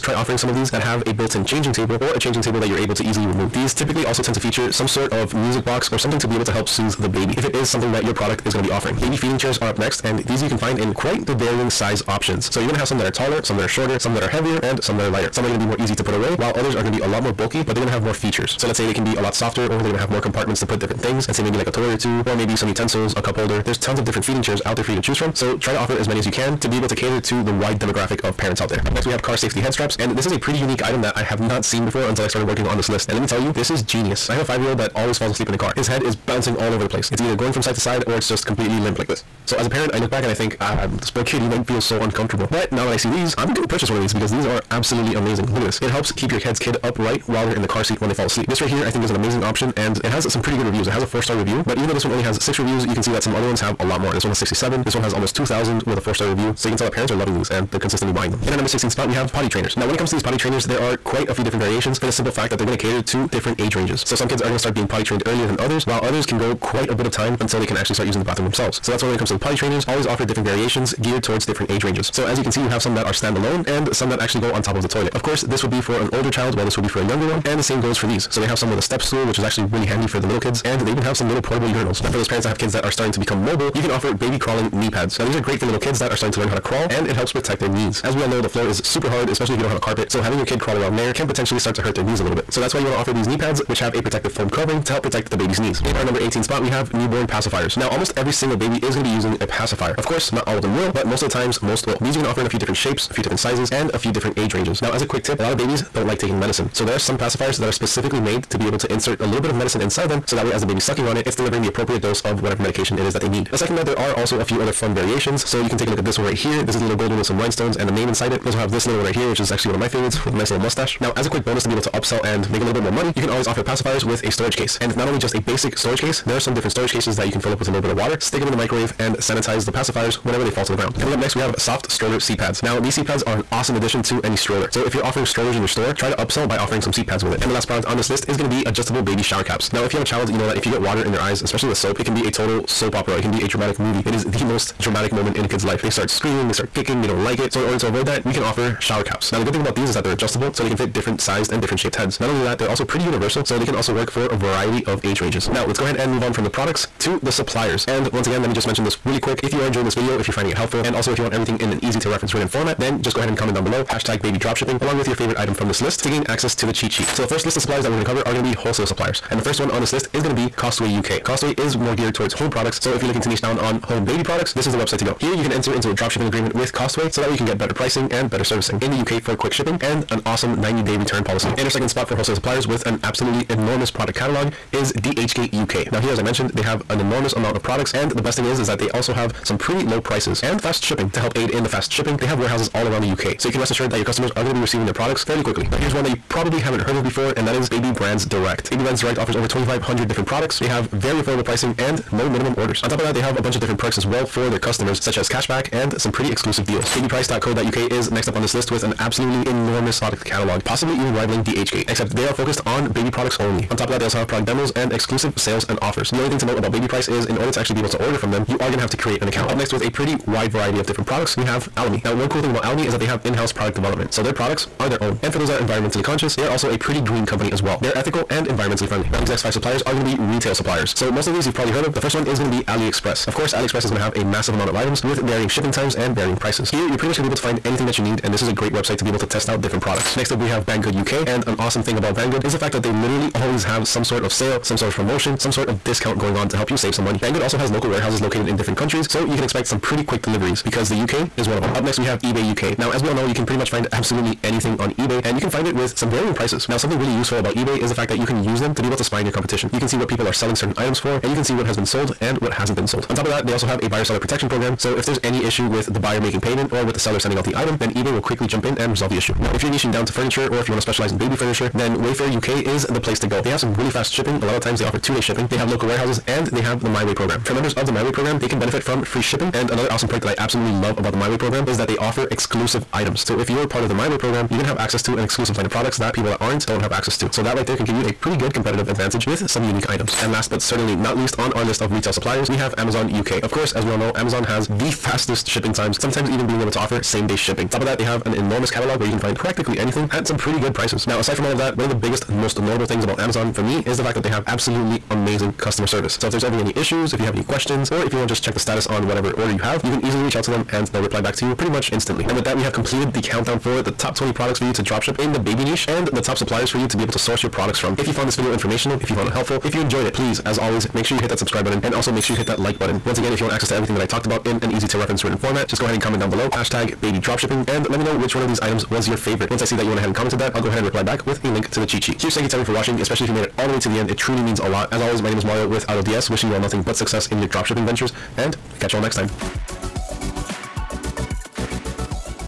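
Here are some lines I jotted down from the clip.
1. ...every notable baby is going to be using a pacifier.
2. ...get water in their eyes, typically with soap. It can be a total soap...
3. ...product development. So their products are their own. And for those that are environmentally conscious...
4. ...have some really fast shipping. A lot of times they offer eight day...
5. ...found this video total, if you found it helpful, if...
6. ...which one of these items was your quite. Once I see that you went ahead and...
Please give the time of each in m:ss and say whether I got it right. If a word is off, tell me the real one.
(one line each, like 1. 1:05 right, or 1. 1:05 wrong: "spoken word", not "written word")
1. 1:38 wrong: "single", not "notable"
2. 2:20 wrong: "especially", not "typically"
3. 3:43 right
4. 4:33 wrong: "two", not "eight"
5. 5:18 wrong: "informational", not "total"
6. 5:28 wrong: "favorite", not "quite".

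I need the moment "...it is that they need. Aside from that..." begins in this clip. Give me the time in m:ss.
1:52.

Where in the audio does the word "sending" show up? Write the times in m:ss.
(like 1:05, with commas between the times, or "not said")
4:27.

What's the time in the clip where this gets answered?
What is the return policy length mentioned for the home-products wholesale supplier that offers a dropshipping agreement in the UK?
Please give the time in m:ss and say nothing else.
3:00.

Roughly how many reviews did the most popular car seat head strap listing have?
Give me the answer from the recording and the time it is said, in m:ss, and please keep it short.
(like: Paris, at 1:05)
almost 2,000, at 0:55.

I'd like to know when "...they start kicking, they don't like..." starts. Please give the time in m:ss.
2:26.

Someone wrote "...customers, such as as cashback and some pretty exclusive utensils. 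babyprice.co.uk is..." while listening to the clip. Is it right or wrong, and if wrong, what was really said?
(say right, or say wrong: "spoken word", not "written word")
wrong: "deals", not "utensils".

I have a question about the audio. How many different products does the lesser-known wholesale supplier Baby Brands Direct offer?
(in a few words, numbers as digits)
over 2,500.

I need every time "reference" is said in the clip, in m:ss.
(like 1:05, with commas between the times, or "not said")
2:42, 5:24.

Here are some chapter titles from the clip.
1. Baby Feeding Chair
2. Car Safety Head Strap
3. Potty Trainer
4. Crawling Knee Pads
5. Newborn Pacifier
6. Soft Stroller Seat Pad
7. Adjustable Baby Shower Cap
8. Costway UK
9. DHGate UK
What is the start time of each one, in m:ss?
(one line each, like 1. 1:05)
1. 0:08
2. 0:29
3. 0:58
4. 1:21
5. 1:35
6. 2:10
7. 2:17
8. 2:49
9. 3:01.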